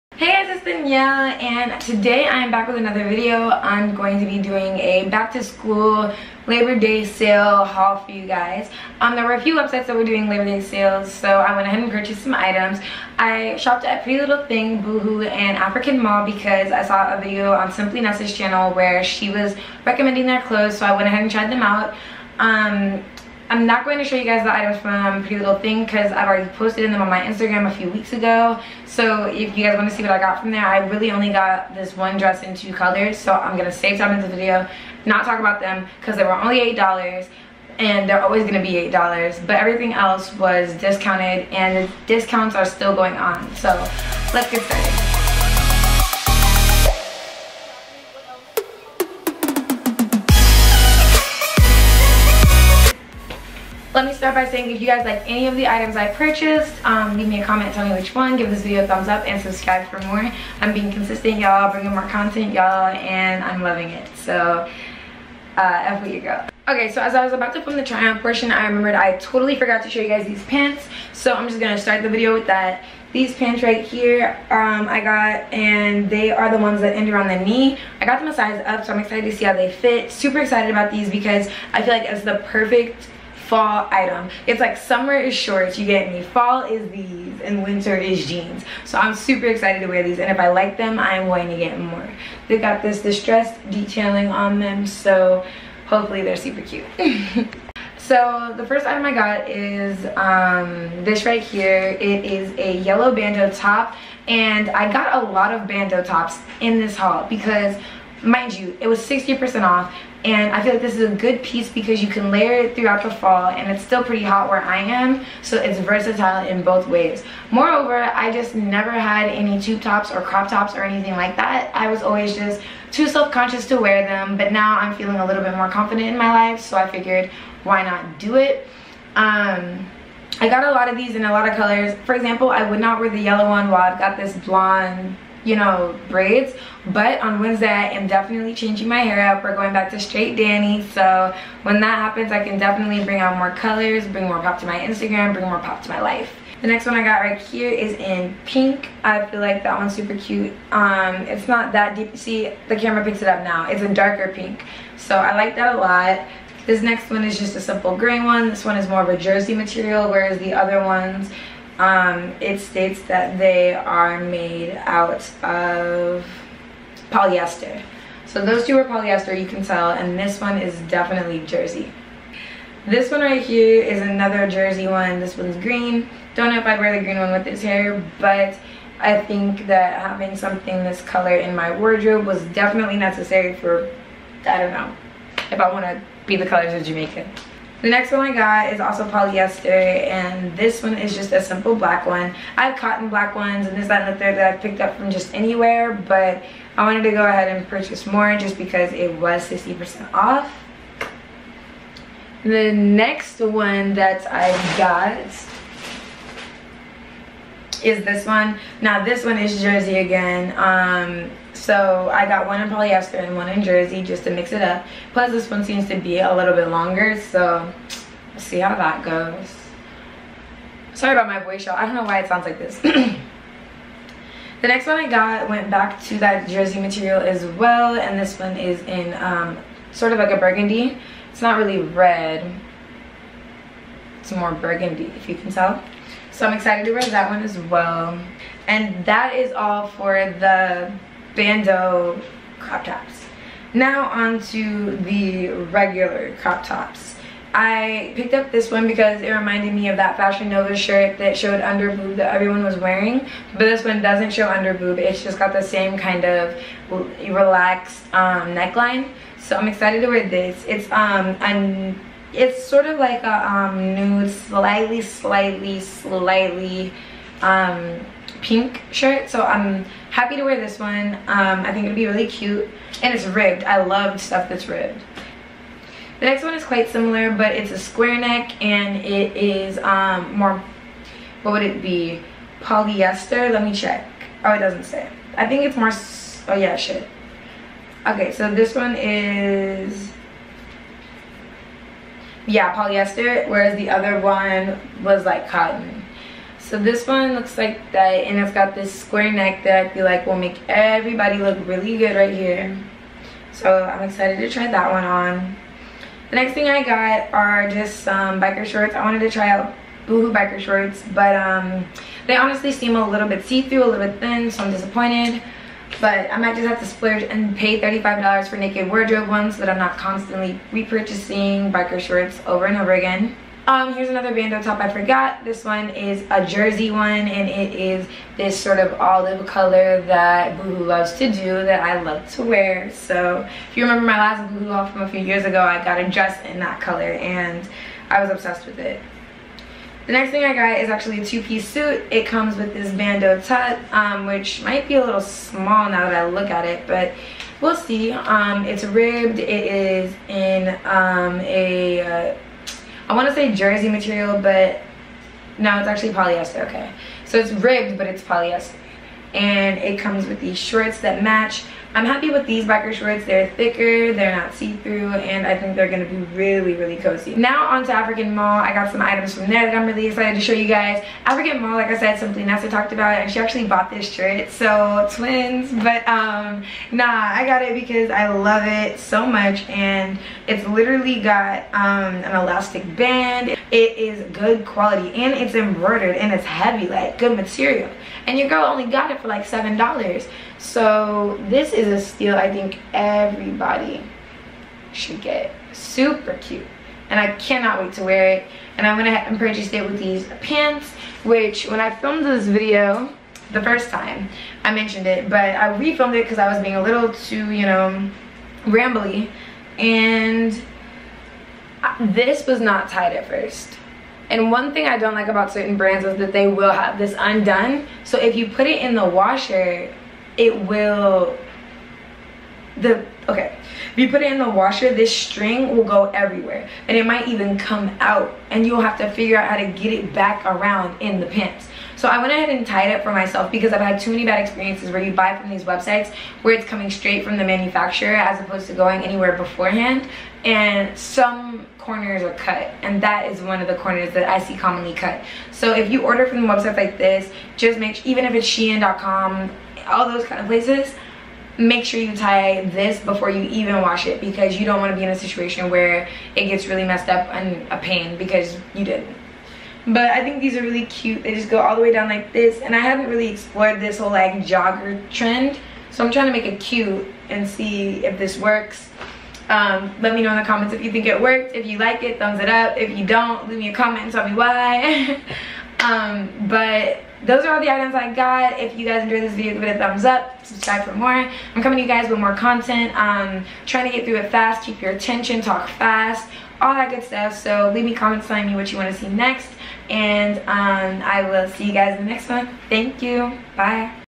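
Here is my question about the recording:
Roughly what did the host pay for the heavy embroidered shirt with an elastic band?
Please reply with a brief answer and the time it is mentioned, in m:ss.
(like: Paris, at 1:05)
$7, at 6:29.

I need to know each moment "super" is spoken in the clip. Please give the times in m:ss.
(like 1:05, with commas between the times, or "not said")
1:20, 1:29, 1:36, 2:29, 6:35.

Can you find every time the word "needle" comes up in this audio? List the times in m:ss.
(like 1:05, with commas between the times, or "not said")
not said.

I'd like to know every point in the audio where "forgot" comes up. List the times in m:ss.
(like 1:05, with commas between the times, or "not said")
1:09, 5:24.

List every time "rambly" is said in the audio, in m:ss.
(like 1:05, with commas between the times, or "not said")
6:48.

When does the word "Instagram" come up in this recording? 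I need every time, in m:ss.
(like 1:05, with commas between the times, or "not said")
0:27, 2:24.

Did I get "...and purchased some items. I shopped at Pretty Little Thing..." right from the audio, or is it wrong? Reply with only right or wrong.
right.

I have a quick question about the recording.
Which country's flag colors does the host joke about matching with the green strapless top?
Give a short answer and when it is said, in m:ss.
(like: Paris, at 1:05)
Jamaica, at 3:06.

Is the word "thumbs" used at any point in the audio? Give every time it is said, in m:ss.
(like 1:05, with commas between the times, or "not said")
0:58, 7:52, 7:59.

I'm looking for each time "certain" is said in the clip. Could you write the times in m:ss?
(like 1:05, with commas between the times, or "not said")
6:55.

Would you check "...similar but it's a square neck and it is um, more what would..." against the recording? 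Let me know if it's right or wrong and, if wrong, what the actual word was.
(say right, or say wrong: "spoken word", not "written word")
right.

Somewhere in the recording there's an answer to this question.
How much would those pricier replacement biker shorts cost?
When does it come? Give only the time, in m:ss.
5:17.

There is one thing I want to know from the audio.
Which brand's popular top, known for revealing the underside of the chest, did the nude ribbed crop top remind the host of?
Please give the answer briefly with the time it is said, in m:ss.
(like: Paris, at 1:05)
Fashion Nova, at 4:10.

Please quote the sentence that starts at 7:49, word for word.
Um, let me know in the comments if you think it worked.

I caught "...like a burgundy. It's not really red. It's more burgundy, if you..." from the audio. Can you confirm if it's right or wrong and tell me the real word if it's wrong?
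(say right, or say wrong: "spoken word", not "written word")
right.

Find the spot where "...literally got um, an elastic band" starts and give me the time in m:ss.
6:20.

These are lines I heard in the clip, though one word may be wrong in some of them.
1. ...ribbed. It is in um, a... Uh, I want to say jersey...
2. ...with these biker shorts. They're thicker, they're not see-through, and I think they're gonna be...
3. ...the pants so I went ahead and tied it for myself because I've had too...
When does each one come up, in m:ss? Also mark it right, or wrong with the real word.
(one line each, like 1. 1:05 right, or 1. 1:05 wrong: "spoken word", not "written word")
1. 5:48 right
2. 6:02 right
3. 7:11 right.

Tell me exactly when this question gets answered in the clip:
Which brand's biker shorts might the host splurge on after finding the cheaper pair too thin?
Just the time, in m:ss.
5:18.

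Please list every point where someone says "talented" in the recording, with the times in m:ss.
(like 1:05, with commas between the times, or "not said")
not said.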